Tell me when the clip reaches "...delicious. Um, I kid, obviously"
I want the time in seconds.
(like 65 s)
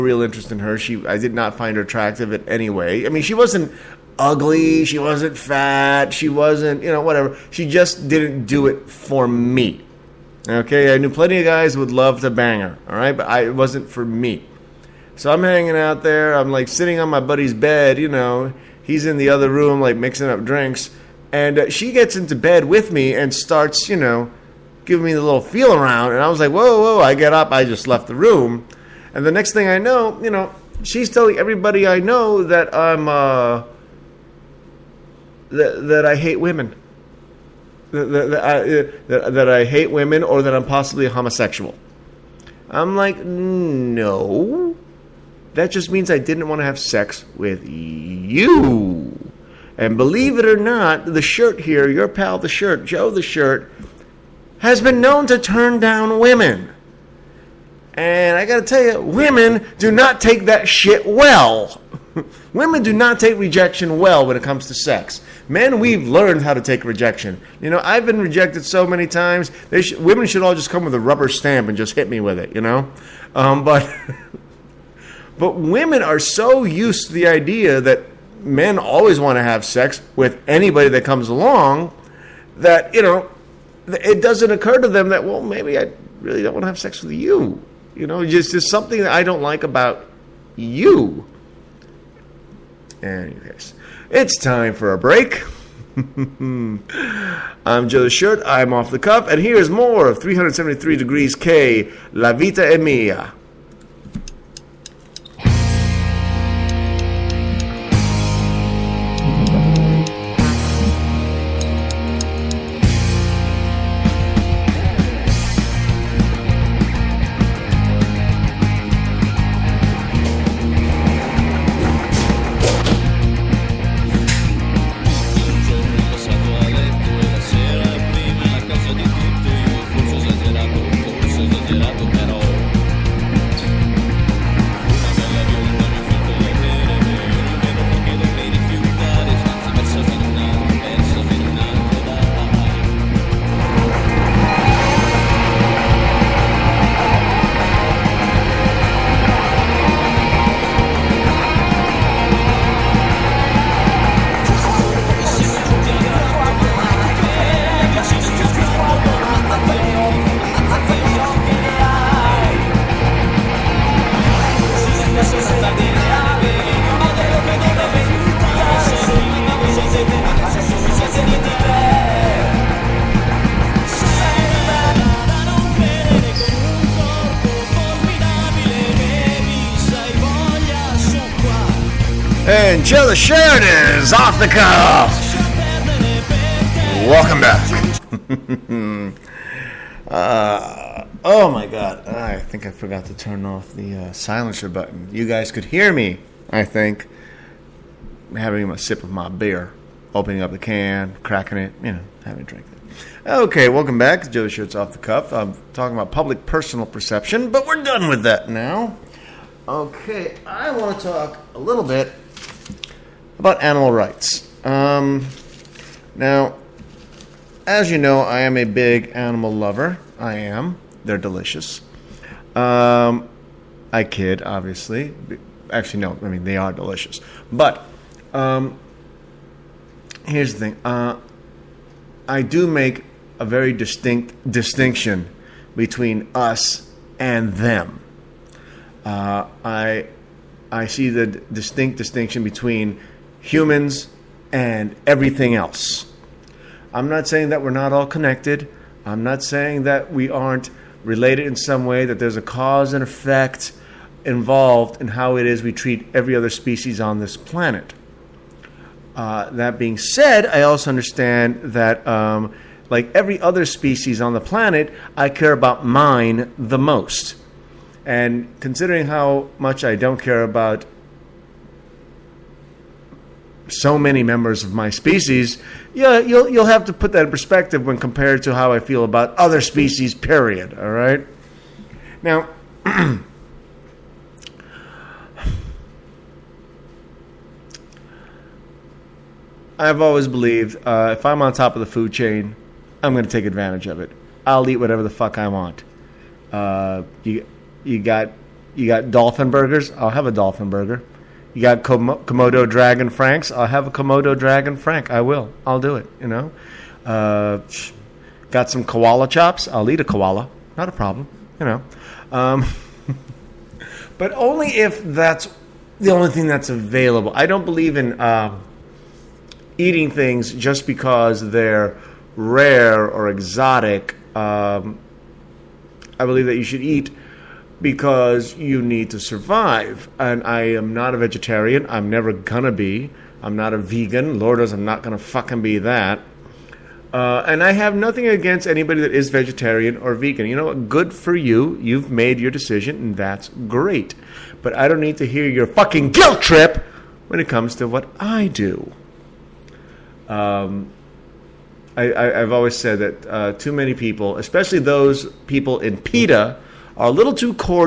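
221 s.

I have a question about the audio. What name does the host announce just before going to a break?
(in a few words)
373 degrees K, La Vita e Mia.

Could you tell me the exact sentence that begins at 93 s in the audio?
Anyways, it's time for a break.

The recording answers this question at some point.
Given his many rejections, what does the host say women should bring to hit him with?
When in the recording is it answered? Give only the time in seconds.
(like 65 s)
70 s.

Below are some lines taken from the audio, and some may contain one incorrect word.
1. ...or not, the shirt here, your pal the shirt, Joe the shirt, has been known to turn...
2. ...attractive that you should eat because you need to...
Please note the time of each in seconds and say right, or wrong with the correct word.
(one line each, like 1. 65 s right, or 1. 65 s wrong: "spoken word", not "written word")
1. 50 s right
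2. 326 s wrong: "believe", not "attractive".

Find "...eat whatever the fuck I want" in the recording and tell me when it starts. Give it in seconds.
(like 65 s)
294 s.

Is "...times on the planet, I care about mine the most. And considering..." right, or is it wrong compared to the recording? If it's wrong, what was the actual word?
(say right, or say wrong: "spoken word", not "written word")
wrong: "species", not "times".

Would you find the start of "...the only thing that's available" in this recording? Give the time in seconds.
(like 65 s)
315 s.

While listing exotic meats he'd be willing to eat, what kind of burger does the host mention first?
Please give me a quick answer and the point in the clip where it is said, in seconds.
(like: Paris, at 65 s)
Dolphin burger, at 300 s.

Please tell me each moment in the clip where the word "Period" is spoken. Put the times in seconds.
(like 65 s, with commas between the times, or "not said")
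280 s.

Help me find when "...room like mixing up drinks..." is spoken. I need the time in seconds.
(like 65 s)
19 s.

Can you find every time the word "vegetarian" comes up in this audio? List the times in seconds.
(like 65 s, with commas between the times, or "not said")
331 s, 339 s.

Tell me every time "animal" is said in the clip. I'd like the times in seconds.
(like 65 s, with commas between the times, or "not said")
213 s, 219 s.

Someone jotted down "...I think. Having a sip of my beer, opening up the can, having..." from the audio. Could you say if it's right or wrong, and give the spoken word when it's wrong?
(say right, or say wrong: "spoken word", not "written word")
wrong: "cracking", not "having".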